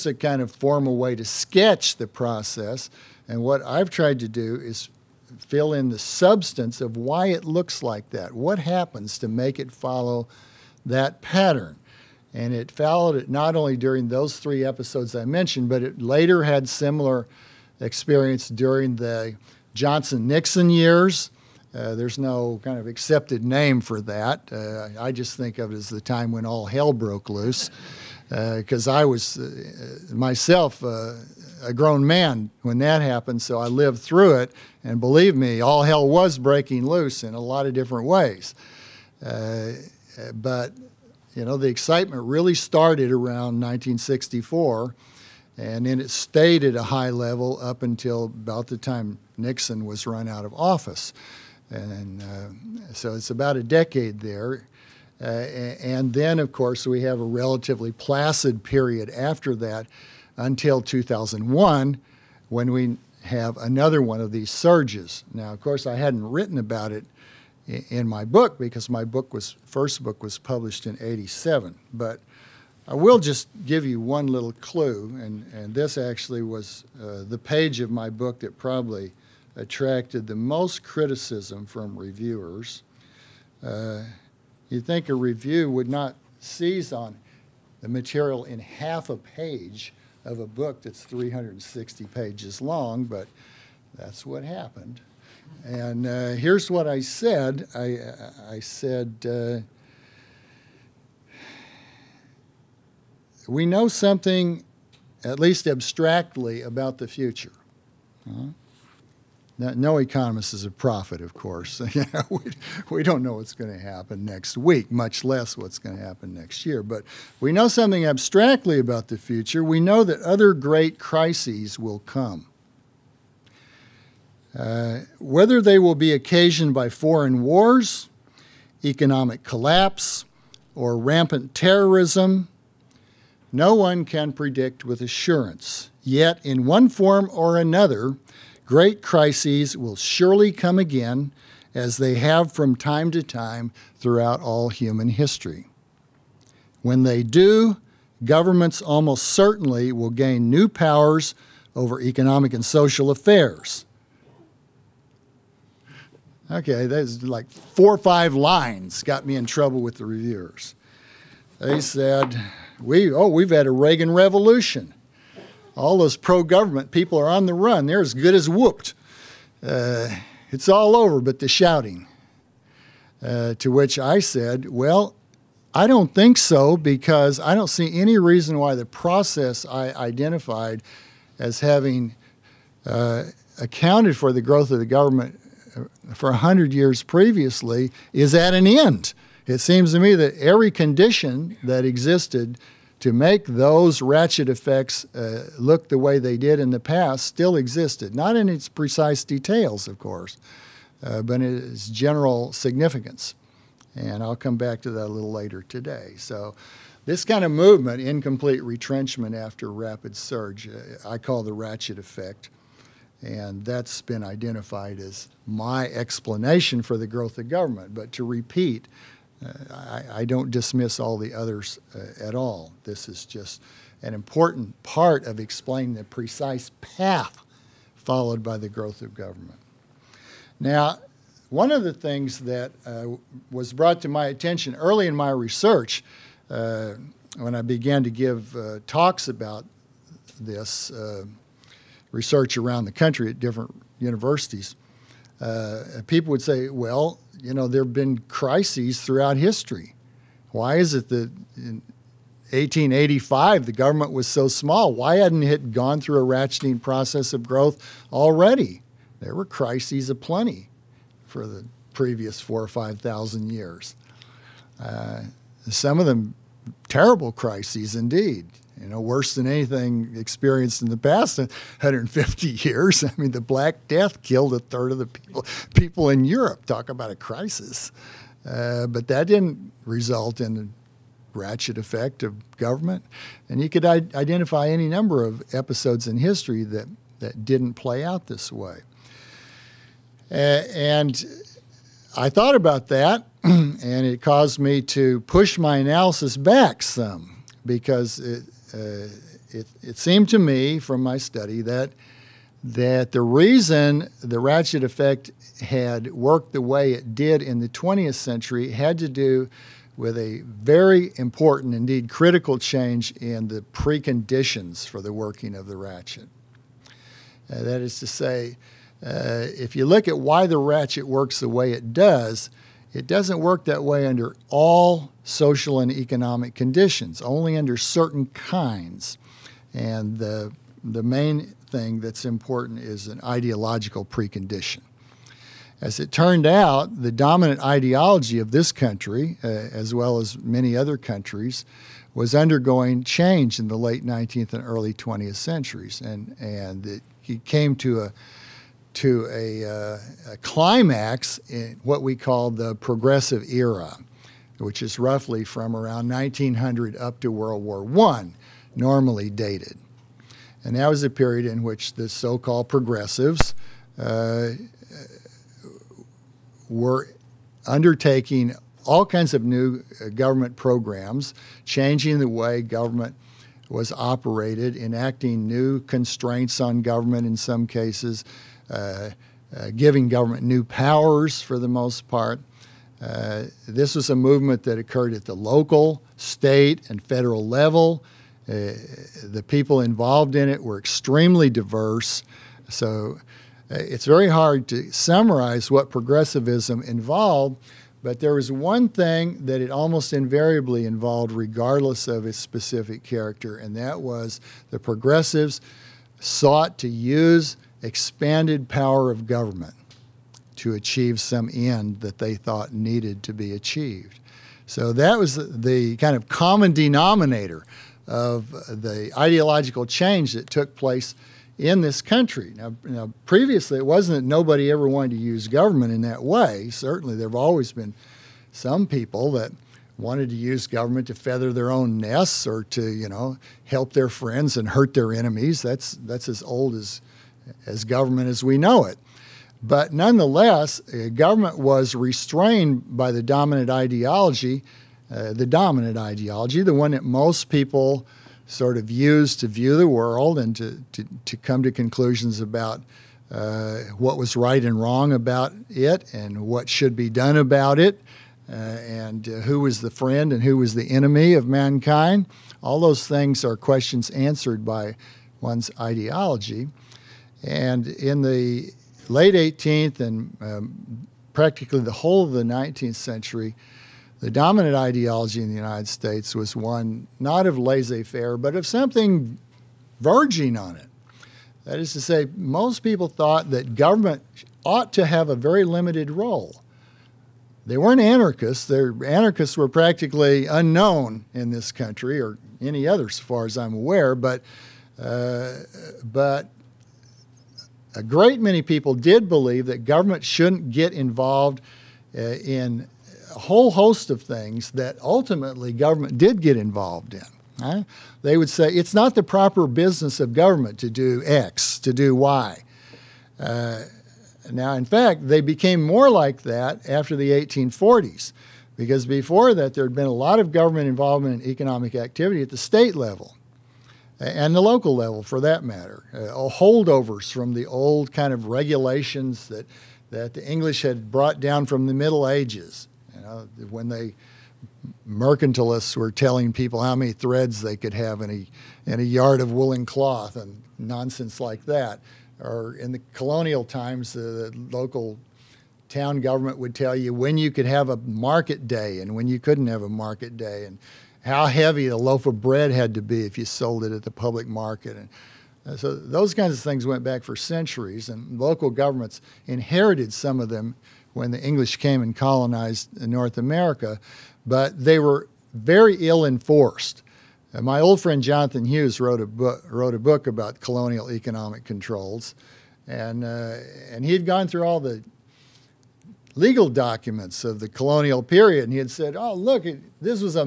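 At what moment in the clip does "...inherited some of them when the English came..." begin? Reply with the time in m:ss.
9:19.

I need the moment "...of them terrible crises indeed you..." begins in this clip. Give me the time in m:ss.
4:25.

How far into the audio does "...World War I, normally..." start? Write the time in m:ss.
5:57.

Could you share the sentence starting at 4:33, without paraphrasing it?
I mean, the Black Death killed a third of the people people in Europe.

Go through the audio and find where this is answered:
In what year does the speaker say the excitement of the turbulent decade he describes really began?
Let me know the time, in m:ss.
0:43.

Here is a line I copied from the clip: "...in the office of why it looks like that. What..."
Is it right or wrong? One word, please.
wrong.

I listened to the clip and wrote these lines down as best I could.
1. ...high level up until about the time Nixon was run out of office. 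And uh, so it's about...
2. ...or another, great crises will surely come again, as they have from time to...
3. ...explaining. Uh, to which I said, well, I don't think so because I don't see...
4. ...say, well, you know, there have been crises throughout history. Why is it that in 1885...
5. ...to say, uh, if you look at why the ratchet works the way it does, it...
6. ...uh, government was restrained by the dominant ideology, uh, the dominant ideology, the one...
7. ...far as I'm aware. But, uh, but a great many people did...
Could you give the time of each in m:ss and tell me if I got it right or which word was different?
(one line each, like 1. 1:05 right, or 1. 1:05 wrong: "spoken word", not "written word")
1. 0:46 right
2. 2:17 right
3. 2:51 wrong: "shouting", not "explaining"
4. 4:06 right
5. 5:17 right
6. 7:20 right
7. 8:13 right.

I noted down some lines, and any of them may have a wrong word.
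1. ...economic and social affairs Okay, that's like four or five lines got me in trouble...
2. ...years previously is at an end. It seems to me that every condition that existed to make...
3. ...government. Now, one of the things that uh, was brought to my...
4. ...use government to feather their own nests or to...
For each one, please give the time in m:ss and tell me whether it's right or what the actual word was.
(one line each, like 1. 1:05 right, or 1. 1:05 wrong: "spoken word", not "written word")
1. 2:32 right
2. 3:06 right
3. 3:49 right
4. 7:10 right.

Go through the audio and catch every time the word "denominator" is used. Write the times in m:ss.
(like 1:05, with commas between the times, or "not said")
6:56.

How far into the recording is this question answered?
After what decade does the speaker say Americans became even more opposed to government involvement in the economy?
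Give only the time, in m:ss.
8:37.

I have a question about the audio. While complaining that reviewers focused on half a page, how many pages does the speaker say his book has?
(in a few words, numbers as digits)
360.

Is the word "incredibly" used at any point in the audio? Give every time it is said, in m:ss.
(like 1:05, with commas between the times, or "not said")
not said.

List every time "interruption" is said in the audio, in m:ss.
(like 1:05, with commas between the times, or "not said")
not said.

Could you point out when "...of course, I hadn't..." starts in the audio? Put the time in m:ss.
1:05.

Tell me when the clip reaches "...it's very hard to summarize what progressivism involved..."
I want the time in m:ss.
6:33.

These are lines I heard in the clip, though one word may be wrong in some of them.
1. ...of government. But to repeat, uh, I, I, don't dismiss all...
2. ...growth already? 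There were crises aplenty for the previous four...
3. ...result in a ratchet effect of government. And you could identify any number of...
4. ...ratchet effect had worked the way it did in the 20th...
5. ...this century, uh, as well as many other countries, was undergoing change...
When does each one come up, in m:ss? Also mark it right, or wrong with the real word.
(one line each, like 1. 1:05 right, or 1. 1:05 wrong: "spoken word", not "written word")
1. 3:37 right
2. 4:17 right
3. 4:39 right
4. 5:04 right
5. 5:38 wrong: "country", not "century".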